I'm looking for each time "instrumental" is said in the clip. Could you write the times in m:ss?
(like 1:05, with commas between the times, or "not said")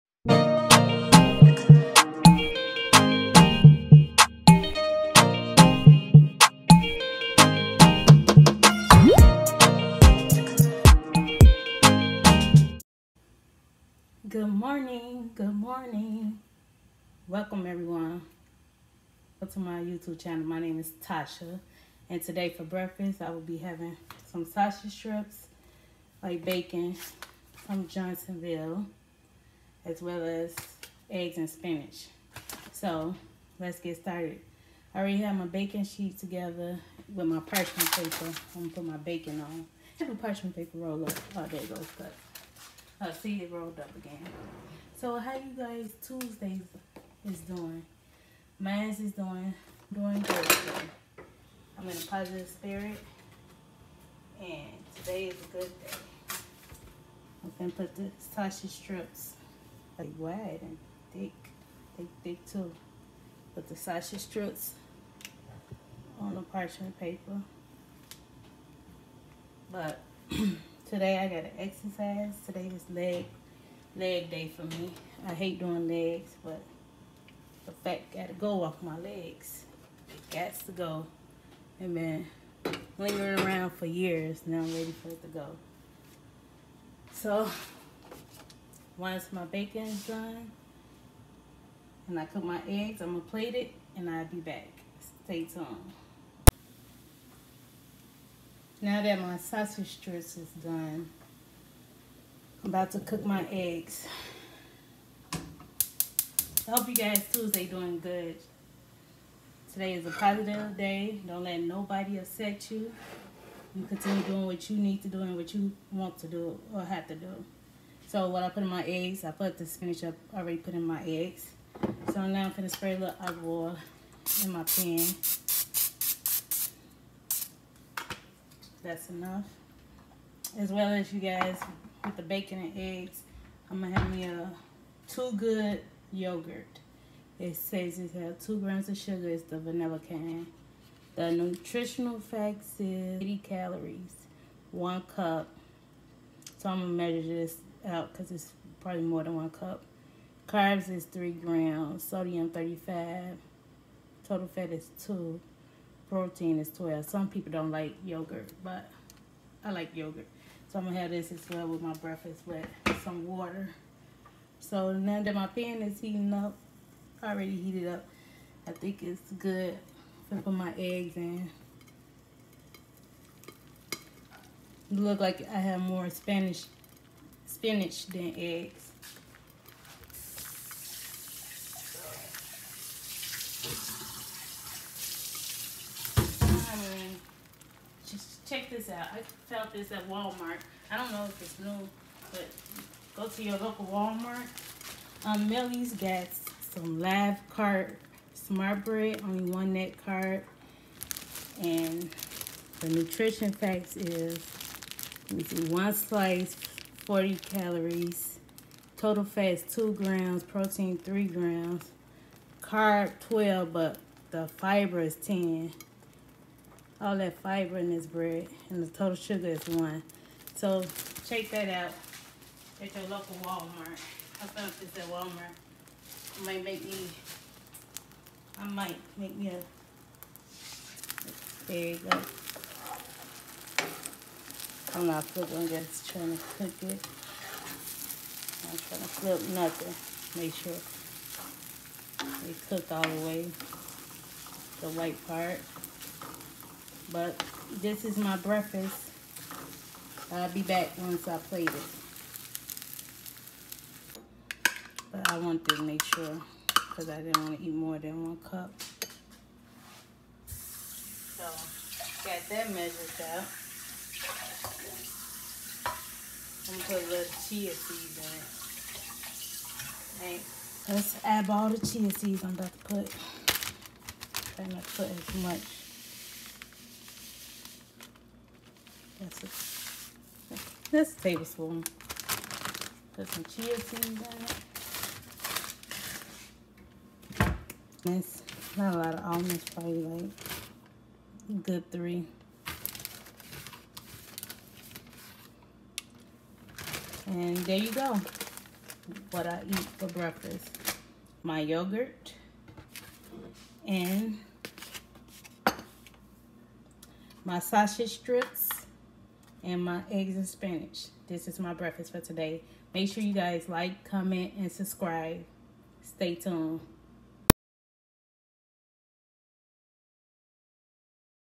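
not said.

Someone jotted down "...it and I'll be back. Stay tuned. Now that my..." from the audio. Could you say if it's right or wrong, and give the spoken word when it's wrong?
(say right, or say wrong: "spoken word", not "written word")
right.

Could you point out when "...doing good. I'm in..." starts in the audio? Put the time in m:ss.
0:49.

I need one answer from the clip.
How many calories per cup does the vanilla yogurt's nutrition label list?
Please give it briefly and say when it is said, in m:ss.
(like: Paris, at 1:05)
80, at 2:23.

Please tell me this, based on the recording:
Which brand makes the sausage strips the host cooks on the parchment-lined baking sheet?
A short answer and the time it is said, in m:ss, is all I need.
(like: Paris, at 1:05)
Johnsonville, at 0:27.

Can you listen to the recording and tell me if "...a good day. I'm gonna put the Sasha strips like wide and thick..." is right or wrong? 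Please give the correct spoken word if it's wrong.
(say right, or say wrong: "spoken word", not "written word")
wrong: "Tasha", not "Sasha".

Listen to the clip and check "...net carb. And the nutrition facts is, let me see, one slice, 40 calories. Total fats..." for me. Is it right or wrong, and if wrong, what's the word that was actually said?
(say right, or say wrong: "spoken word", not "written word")
right.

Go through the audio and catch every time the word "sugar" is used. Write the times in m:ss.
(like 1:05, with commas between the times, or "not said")
2:18, 3:39.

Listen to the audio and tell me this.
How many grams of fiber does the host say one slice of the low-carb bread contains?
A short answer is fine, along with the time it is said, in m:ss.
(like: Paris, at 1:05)
10, at 3:35.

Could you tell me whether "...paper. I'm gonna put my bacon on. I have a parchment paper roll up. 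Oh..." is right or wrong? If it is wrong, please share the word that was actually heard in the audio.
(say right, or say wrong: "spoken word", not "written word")
right.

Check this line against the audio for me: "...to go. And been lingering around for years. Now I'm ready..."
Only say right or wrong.
right.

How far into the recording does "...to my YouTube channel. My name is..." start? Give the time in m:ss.
0:19.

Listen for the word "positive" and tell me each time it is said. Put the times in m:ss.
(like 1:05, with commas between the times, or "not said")
0:52, 1:50.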